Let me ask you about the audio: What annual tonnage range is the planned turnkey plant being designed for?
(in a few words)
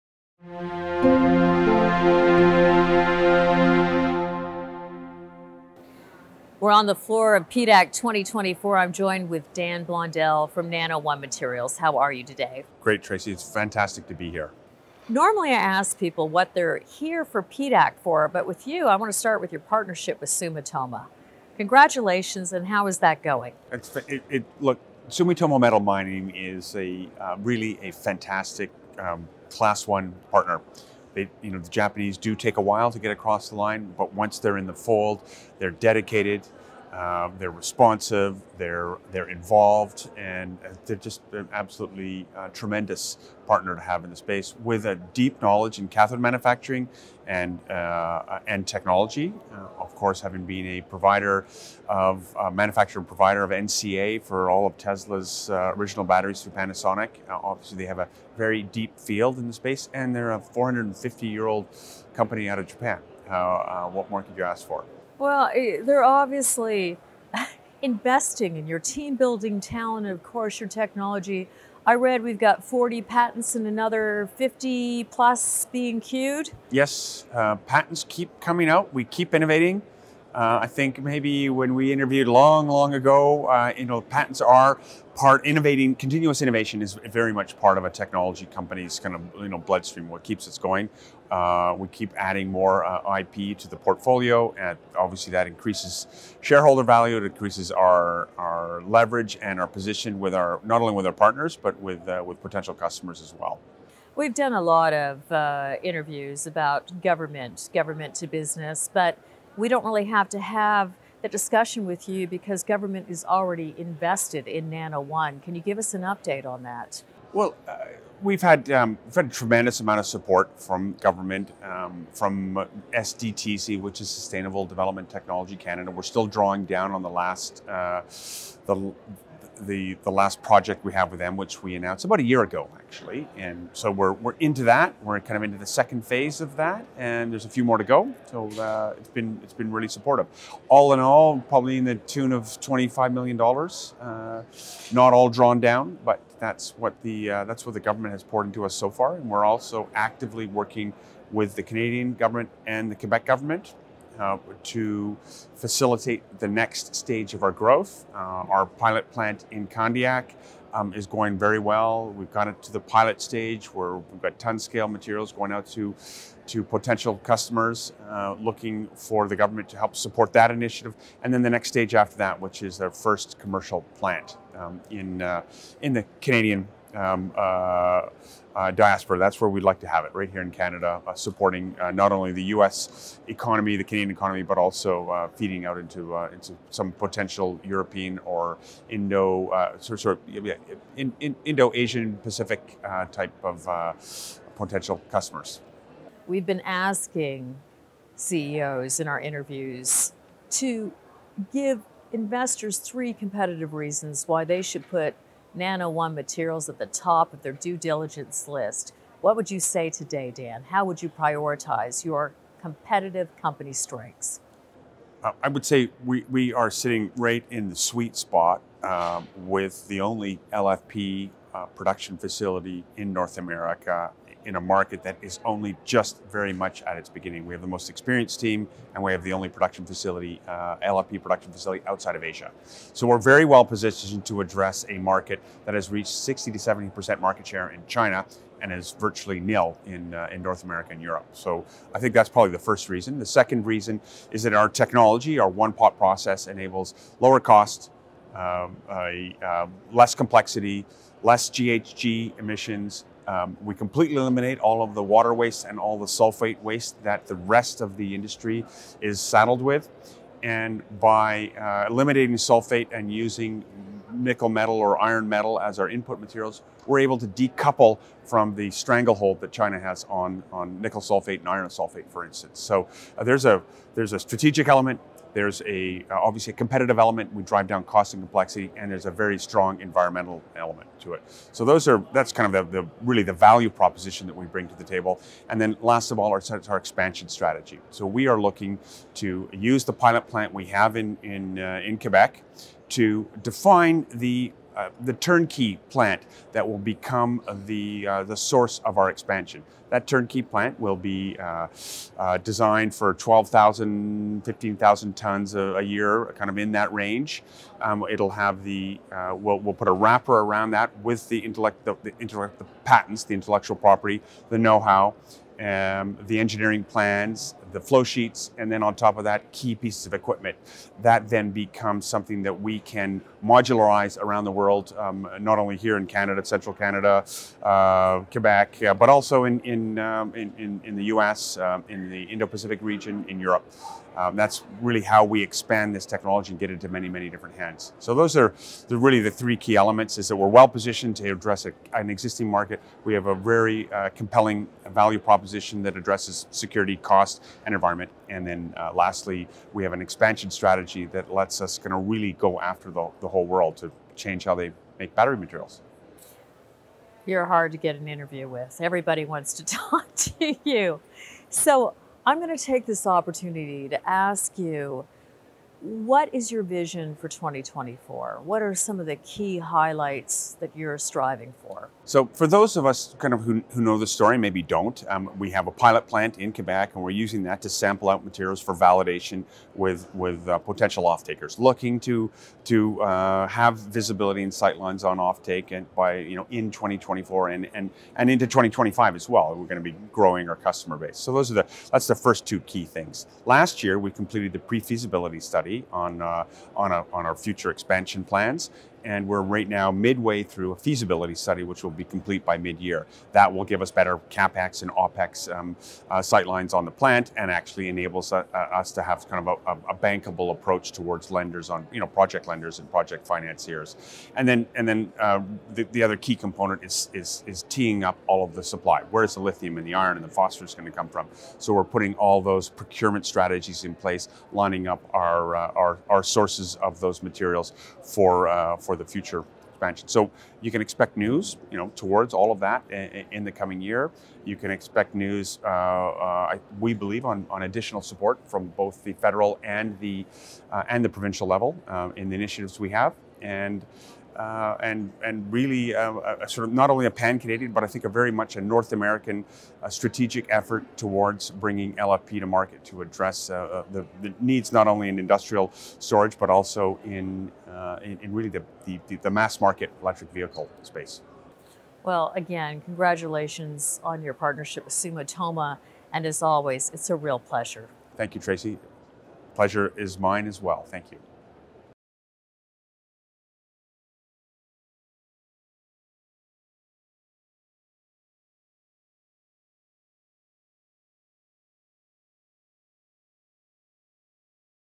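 12,000 to 15,000 tons.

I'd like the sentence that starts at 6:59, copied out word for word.
Where's the lithium and the iron and the phosphorus going to come from?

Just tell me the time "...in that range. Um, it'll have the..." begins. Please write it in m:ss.
5:06.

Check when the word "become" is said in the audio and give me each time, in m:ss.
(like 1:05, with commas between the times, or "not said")
4:56, 5:21.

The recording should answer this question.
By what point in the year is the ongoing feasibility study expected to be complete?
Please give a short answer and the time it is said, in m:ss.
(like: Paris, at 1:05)
mid-year, at 6:42.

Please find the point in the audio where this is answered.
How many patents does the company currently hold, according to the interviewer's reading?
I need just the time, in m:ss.
1:12.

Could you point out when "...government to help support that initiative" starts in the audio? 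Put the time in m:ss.
2:49.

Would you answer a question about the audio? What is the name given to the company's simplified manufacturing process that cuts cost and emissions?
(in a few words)
one pot process.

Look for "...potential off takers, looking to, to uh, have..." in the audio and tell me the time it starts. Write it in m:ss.
6:20.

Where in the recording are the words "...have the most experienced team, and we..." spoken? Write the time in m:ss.
3:47.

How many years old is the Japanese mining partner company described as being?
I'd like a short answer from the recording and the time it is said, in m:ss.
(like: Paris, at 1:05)
450, at 1:00.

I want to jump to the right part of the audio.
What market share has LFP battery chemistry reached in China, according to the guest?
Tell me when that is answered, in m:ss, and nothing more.
3:56.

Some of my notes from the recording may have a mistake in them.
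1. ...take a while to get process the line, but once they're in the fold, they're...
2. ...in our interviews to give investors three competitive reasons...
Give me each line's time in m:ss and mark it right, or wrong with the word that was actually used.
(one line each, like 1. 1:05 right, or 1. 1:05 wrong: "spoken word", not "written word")
1. 0:32 wrong: "across", not "process"
2. 3:18 right.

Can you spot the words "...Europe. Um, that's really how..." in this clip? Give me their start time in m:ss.
5:33.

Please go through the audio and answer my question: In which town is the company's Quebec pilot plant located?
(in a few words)
Candiac.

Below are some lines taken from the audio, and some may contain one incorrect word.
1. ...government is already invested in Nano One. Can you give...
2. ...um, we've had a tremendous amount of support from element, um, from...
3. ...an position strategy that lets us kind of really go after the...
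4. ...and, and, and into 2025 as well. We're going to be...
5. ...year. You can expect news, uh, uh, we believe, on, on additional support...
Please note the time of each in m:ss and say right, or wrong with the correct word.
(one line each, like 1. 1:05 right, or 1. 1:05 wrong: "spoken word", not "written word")
1. 1:52 right
2. 1:58 wrong: "government", not "element"
3. 5:49 wrong: "expansion", not "position"
4. 6:27 right
5. 7:13 right.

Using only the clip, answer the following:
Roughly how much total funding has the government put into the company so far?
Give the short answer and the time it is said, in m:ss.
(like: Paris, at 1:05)
$25 million, at 2:22.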